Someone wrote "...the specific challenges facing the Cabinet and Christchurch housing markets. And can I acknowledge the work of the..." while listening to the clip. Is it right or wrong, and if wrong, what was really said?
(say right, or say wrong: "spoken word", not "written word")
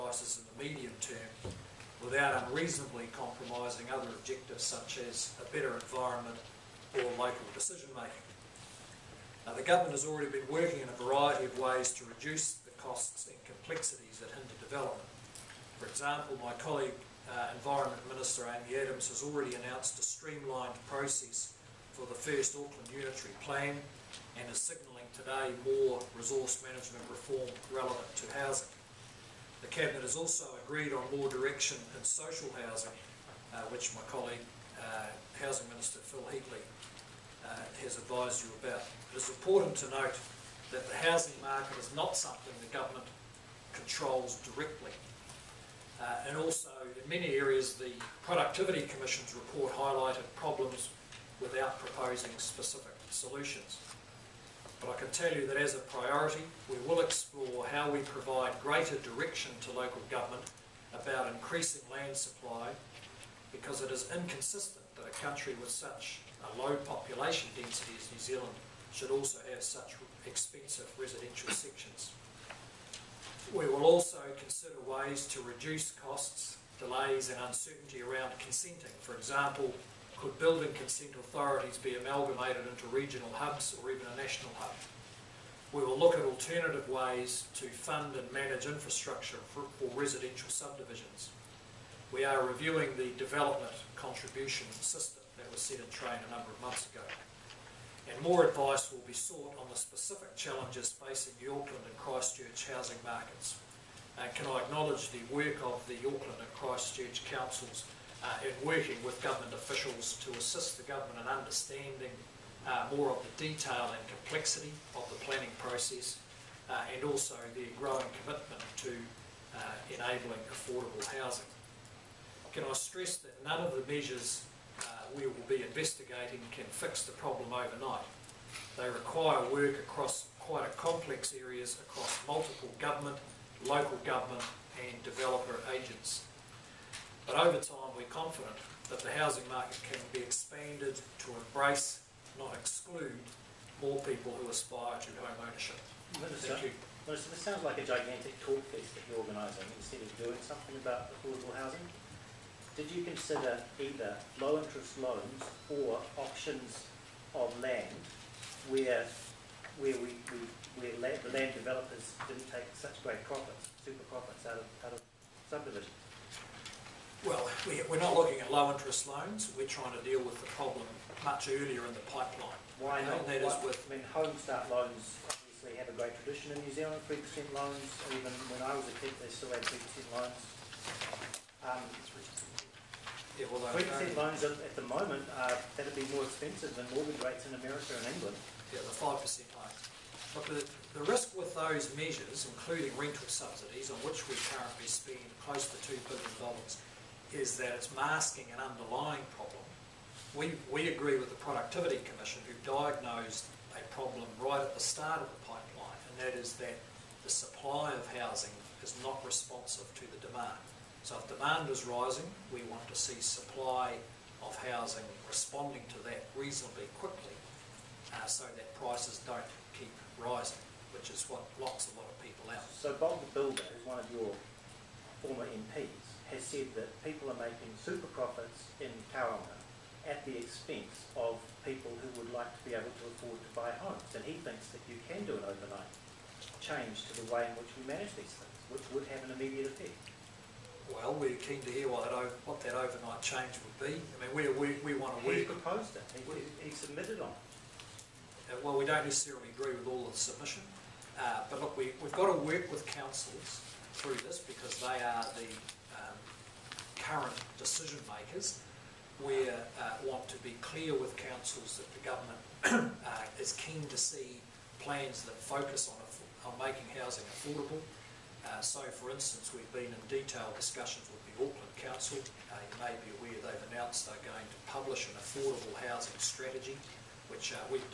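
wrong: "Auckland", not "Cabinet".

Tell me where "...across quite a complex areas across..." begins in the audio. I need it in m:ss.
2:09.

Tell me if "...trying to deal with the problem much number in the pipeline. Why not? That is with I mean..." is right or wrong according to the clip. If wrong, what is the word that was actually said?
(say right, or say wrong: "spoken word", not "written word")
wrong: "earlier", not "number".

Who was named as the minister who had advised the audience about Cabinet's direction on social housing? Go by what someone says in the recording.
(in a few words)
Phil Heatley.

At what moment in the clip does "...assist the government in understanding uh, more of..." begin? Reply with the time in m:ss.
1:50.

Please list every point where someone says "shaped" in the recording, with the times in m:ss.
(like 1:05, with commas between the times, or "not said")
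not said.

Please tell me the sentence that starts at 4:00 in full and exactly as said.
Well, we're keen to hear what that, what that overnight change would be.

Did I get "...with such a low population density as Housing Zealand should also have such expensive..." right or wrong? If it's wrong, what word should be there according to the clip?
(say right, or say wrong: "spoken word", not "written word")
wrong: "New", not "Housing".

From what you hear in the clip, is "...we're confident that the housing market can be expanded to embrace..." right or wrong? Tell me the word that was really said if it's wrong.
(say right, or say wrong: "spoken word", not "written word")
right.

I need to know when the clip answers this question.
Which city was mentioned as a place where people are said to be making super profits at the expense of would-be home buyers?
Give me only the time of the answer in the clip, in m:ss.
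3:49.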